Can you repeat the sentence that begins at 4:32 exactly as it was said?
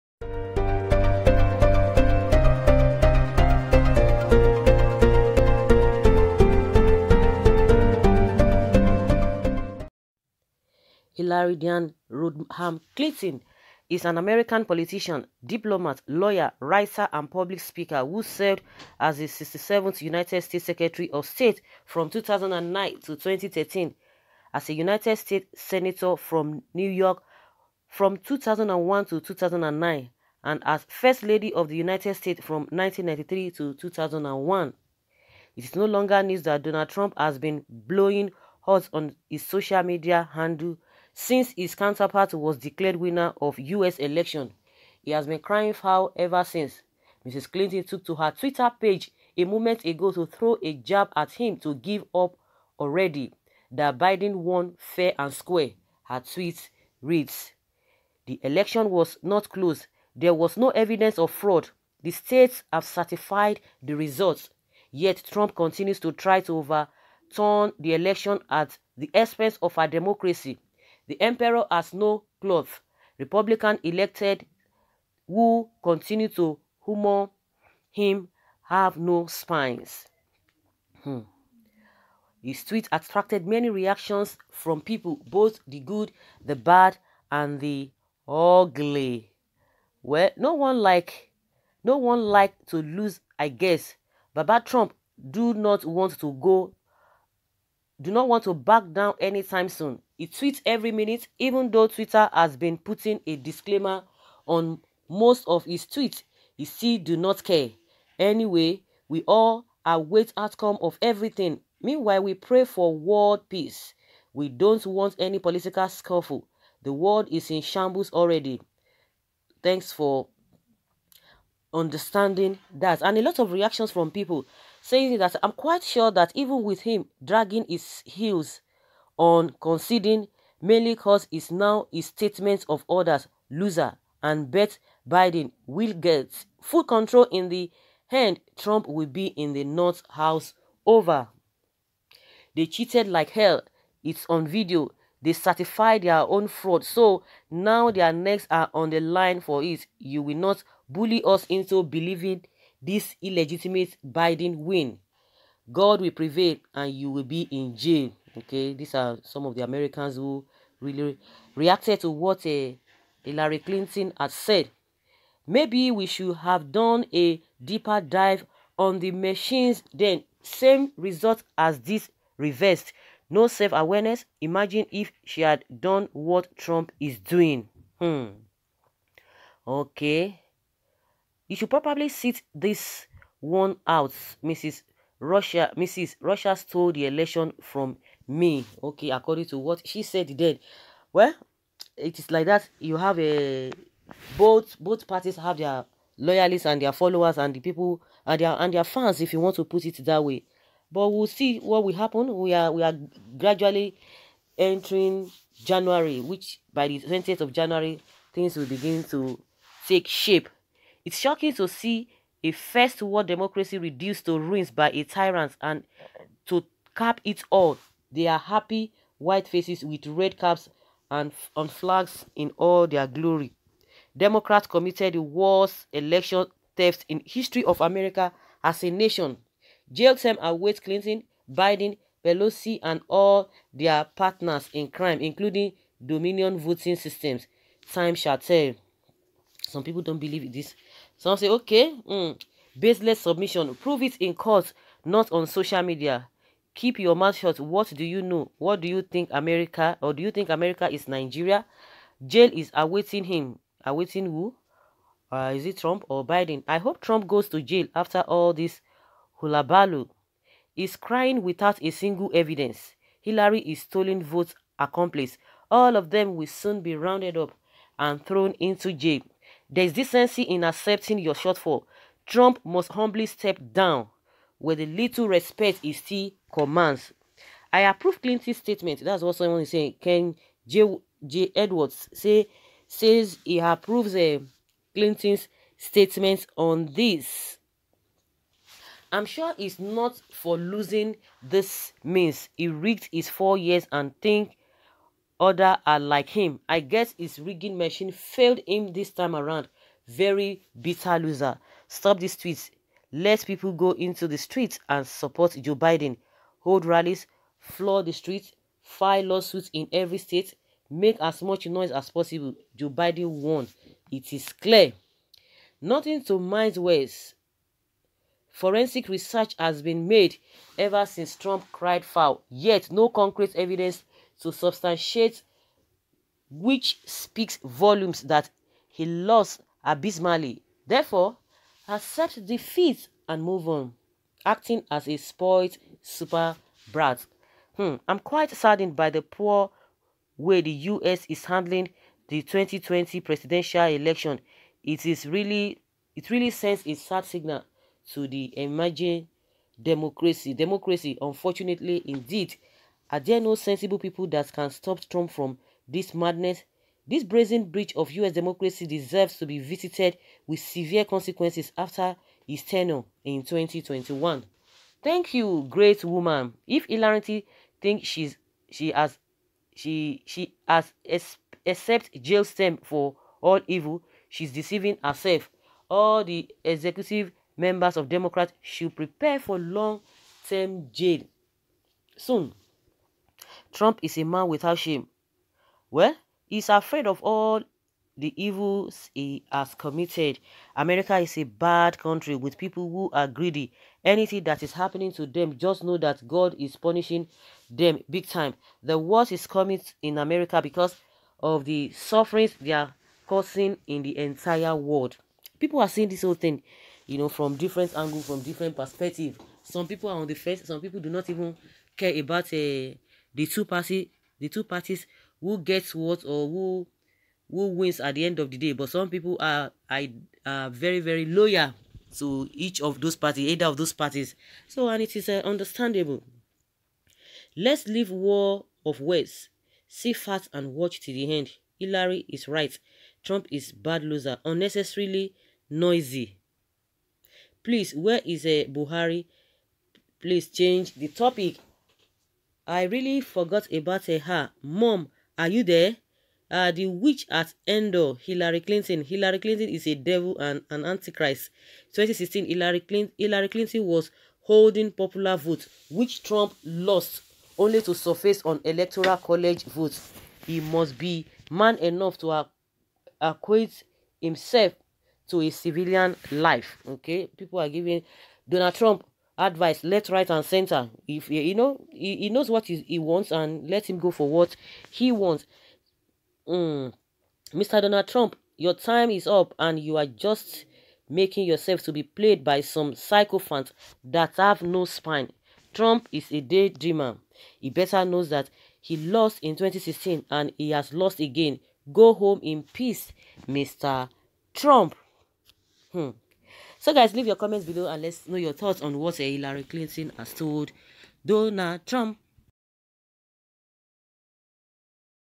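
Trump must humbly step down where the little respect is still commands.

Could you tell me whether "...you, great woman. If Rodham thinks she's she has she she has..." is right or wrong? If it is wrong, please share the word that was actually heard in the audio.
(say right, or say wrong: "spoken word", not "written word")
wrong: "Hilarity", not "Rodham".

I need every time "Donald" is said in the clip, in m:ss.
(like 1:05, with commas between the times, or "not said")
0:36, 7:48, 7:57, 8:21.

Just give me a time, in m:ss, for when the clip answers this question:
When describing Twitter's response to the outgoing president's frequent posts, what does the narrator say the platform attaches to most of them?
1:43.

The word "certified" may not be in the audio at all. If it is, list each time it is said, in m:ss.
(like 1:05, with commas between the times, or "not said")
1:02, 2:25.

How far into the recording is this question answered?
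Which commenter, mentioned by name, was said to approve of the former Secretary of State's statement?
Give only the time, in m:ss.
4:40.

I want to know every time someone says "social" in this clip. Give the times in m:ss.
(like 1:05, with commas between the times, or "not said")
0:39, 4:05.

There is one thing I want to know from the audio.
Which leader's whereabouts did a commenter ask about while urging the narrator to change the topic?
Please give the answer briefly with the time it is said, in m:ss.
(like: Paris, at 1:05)
Buhari, at 7:18.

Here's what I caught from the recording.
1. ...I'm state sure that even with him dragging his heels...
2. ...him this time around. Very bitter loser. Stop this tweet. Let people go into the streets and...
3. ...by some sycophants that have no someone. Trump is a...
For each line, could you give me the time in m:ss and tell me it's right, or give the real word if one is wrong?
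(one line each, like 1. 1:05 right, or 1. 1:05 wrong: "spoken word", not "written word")
1. 2:05 wrong: "quite", not "state"
2. 4:58 right
3. 8:02 wrong: "spine", not "someone".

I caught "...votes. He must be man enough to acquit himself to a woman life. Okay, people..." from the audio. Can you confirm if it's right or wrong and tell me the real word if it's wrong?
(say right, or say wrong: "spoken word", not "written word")
wrong: "civilian", not "woman".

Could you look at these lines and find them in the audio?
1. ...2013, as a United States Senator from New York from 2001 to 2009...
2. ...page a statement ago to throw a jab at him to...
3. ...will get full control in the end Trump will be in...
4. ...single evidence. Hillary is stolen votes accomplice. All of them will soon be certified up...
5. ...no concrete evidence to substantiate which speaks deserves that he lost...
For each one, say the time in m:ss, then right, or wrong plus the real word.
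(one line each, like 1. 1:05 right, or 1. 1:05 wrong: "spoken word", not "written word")
1. 0:23 right
2. 0:48 wrong: "moment", not "statement"
3. 2:15 right
4. 4:21 wrong: "rounded", not "certified"
5. 5:22 wrong: "volumes", not "deserves".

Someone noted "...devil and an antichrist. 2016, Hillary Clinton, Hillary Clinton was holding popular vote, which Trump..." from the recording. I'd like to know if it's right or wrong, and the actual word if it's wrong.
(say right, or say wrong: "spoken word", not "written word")
right.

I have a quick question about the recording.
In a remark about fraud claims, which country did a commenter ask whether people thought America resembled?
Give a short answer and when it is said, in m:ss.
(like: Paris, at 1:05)
Nigeria, at 4:11.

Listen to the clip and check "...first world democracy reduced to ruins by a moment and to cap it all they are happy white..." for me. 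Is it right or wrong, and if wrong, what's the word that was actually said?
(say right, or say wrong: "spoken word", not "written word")
wrong: "tyrant", not "moment".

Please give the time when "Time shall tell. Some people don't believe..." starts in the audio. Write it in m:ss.
3:57.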